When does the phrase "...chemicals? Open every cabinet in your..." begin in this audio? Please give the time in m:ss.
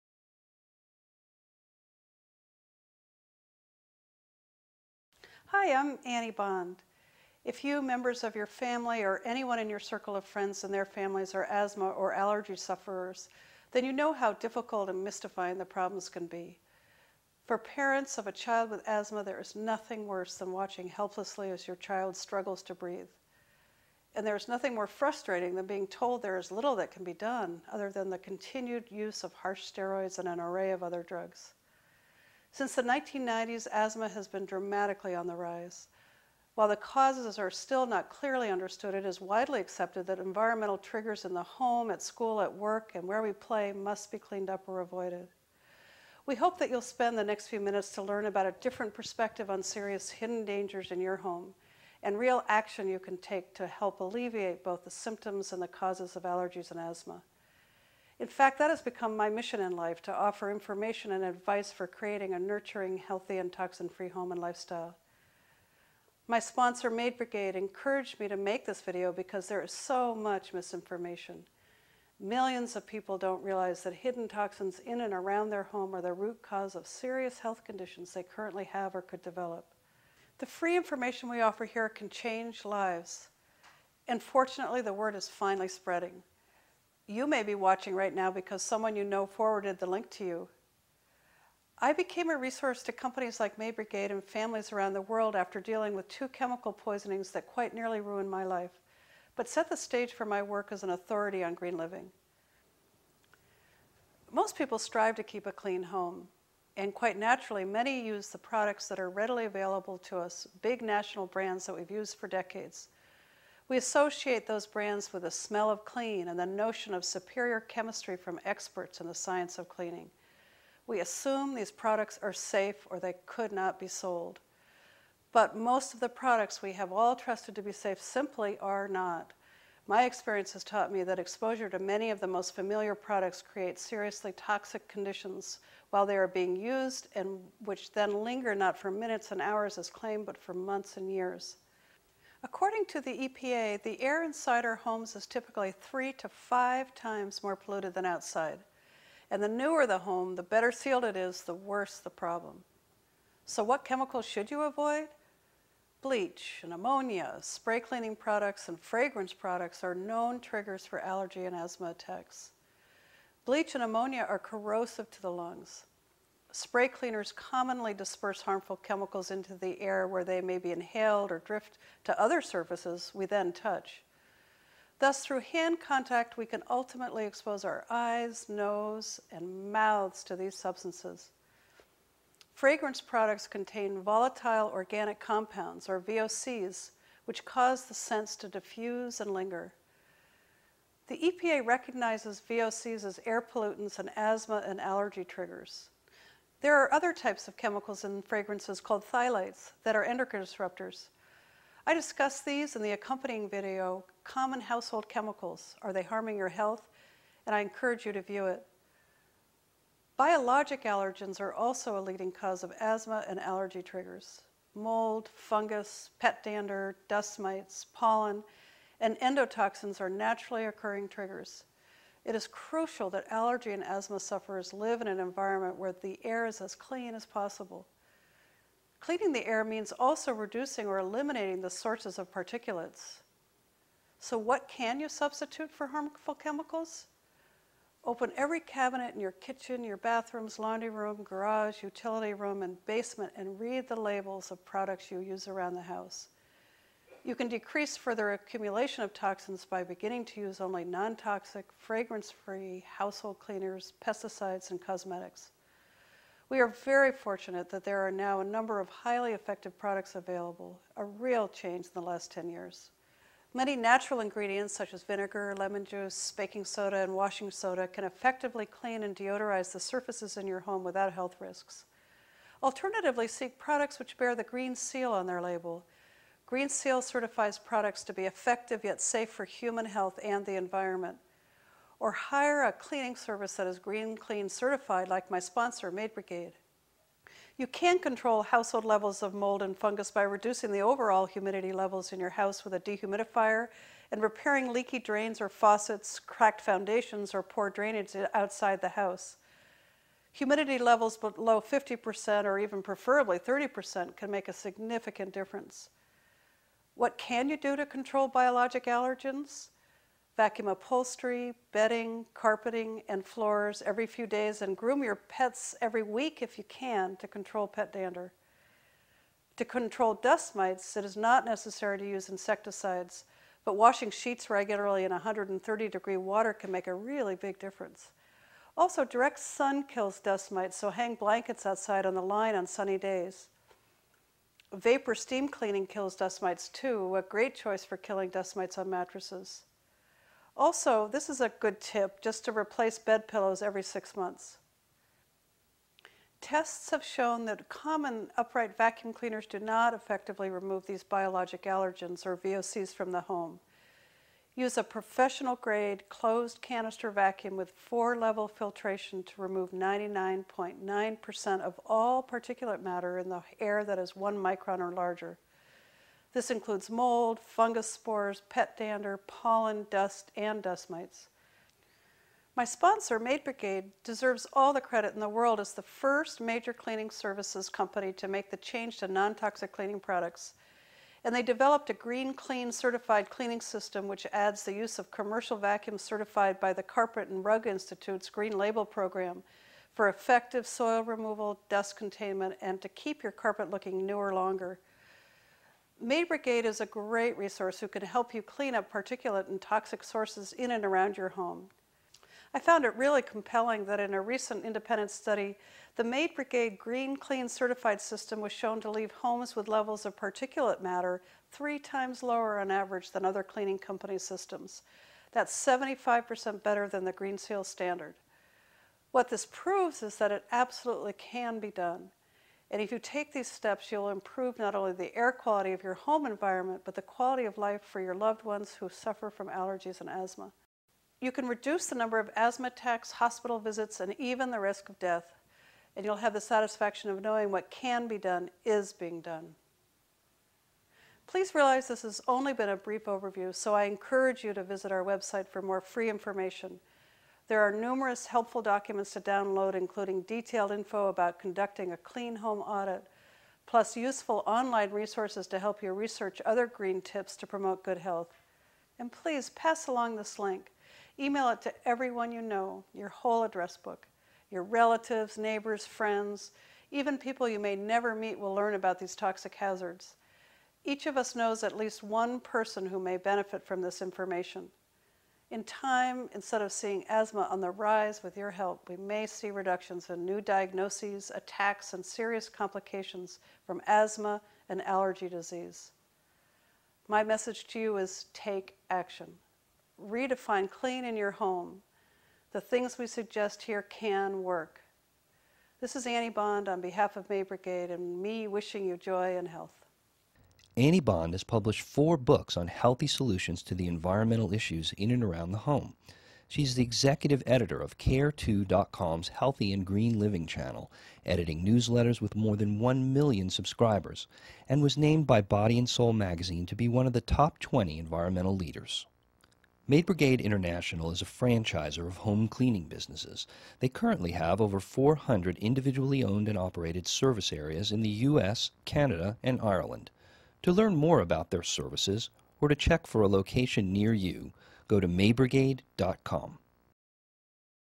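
3:56.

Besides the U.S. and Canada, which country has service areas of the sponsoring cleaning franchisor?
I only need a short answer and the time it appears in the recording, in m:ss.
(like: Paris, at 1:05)
Ireland, at 8:49.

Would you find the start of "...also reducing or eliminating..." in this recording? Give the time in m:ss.
3:49.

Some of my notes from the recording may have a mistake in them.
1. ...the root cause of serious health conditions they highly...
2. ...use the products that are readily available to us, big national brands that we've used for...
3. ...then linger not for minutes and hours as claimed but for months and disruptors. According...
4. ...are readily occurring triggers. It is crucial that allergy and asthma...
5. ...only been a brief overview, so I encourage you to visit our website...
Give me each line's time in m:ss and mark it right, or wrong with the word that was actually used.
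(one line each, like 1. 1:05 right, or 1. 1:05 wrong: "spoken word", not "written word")
1. 1:16 wrong: "currently", not "highly"
2. 1:48 right
3. 2:17 wrong: "years", not "disruptors"
4. 3:39 wrong: "naturally", not "readily"
5. 7:22 right.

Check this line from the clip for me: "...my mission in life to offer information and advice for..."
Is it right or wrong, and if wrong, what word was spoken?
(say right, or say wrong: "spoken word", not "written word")
right.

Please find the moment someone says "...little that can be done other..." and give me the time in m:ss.
0:26.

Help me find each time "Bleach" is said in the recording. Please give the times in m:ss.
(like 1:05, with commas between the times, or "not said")
2:36, 2:43.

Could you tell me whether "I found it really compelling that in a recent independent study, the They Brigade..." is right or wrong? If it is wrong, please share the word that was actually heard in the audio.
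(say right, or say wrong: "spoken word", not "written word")
wrong: "Maid", not "They".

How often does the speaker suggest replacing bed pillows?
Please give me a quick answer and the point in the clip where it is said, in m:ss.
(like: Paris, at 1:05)
Every six months, at 5:43.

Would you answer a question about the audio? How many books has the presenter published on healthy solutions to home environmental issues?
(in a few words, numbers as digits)
4.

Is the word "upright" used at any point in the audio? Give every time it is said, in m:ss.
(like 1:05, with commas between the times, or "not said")
5:48.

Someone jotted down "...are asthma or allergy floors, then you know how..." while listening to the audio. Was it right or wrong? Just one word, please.
wrong.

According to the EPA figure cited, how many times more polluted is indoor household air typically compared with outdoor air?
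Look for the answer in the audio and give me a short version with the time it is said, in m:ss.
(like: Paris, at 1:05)
3 to 5 times, at 2:25.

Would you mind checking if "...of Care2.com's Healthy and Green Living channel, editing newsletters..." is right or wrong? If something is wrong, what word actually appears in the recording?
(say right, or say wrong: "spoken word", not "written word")
right.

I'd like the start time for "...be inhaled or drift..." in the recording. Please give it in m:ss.
2:50.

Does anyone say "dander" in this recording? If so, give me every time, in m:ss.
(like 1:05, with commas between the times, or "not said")
3:36, 5:17, 6:08.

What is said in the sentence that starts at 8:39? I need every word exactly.
Maid Brigade International is a franchisor of home cleaning businesses.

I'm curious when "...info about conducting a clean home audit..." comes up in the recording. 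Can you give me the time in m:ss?
7:30.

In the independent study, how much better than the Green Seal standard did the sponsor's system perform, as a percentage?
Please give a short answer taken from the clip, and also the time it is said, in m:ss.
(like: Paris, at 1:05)
75%, at 6:55.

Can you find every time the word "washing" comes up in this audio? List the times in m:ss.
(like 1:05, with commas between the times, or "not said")
4:27, 5:23.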